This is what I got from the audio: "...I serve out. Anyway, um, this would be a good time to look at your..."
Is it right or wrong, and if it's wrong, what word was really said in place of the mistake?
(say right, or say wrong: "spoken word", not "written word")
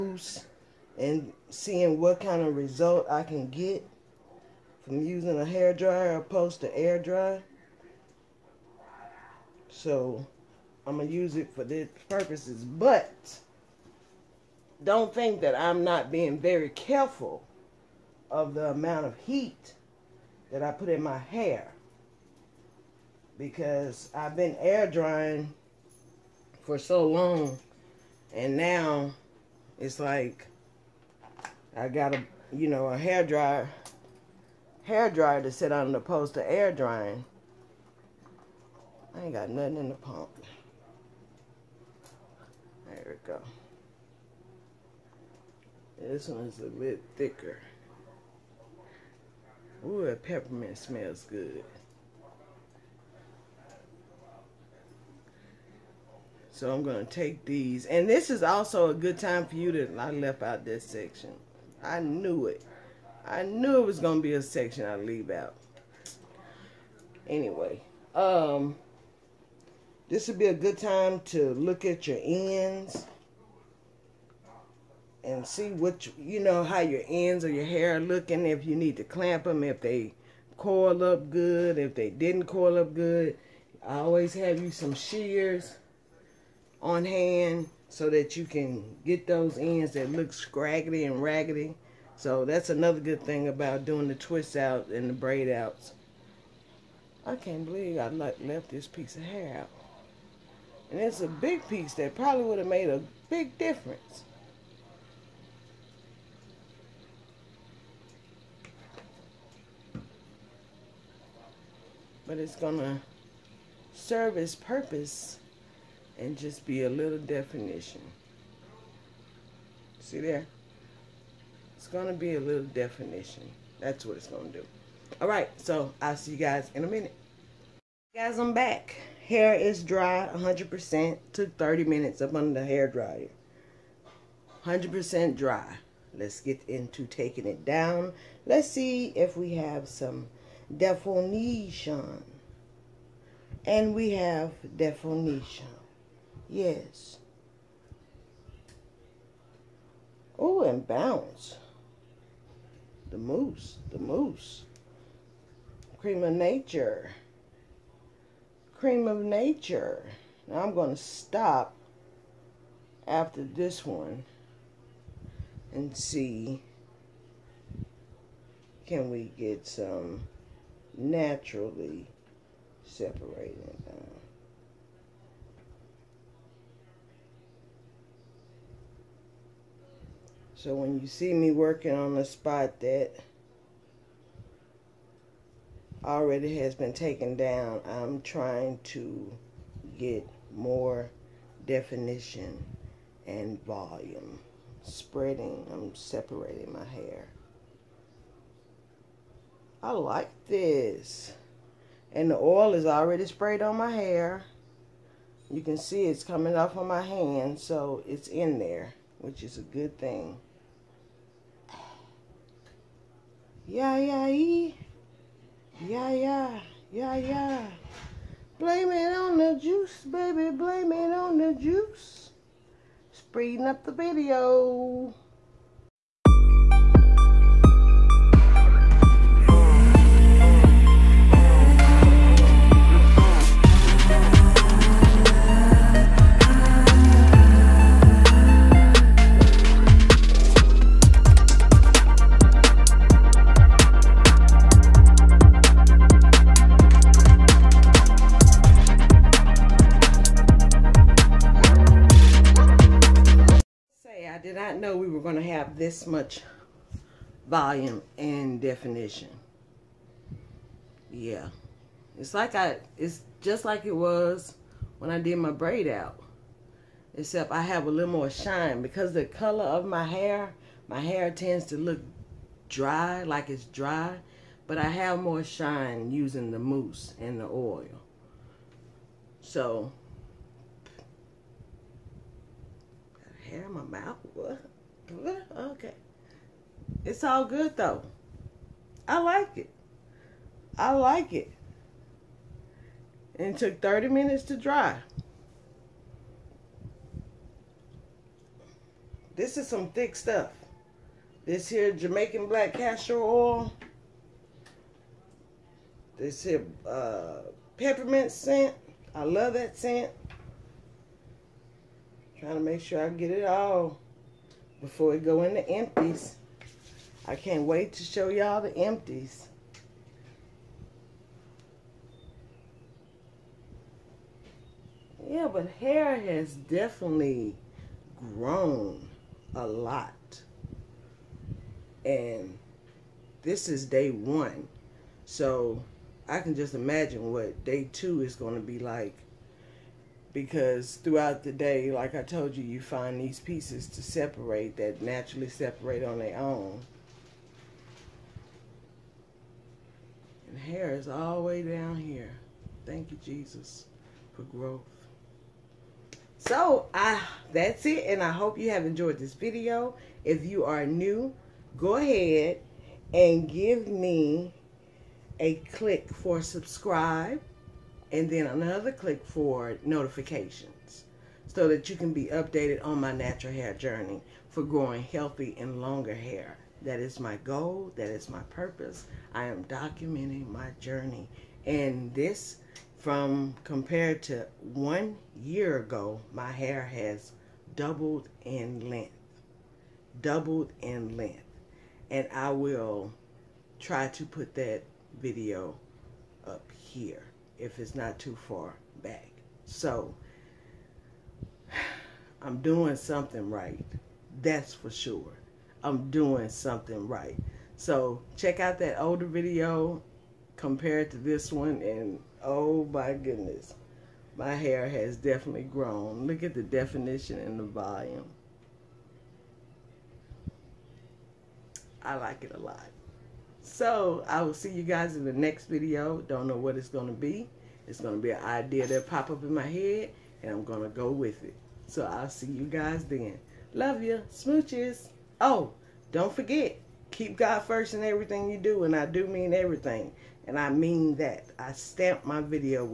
wrong: "leave", not "serve".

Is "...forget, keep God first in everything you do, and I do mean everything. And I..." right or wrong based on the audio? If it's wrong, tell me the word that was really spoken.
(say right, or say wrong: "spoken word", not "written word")
right.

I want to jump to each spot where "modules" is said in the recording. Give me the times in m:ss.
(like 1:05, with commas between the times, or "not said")
not said.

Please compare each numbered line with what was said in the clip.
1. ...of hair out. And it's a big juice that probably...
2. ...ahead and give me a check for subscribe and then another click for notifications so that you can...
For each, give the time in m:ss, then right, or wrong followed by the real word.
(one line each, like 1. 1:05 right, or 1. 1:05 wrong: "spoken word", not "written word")
1. 1:39 wrong: "piece", not "juice"
2. 6:01 wrong: "click", not "check".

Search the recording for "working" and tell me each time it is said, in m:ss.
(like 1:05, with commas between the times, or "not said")
3:01.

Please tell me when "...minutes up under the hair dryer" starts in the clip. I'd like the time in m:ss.
2:11.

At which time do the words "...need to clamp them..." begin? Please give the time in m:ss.
1:18.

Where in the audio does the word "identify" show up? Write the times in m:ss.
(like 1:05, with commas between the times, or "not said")
not said.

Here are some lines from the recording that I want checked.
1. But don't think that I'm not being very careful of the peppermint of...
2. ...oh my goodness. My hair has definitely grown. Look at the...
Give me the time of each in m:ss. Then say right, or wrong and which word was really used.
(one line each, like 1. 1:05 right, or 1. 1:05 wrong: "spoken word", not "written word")
1. 0:12 wrong: "amount", not "peppermint"
2. 6:52 right.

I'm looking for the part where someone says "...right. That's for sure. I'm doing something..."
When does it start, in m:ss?
6:43.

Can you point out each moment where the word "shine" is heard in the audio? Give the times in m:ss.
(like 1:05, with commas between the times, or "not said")
4:28, 4:35.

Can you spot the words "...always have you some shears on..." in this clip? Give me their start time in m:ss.
1:23.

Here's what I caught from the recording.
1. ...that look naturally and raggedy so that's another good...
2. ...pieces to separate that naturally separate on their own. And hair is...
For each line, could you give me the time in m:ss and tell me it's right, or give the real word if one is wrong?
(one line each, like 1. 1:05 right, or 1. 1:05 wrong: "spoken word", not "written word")
1. 1:29 wrong: "scraggly", not "naturally"
2. 5:43 right.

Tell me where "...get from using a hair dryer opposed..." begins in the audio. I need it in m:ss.
0:03.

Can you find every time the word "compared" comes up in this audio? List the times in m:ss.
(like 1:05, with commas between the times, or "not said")
6:23, 6:50.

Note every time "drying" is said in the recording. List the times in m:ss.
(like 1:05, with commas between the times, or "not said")
0:24, 0:36.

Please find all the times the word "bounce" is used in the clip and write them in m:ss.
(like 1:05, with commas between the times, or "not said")
2:30.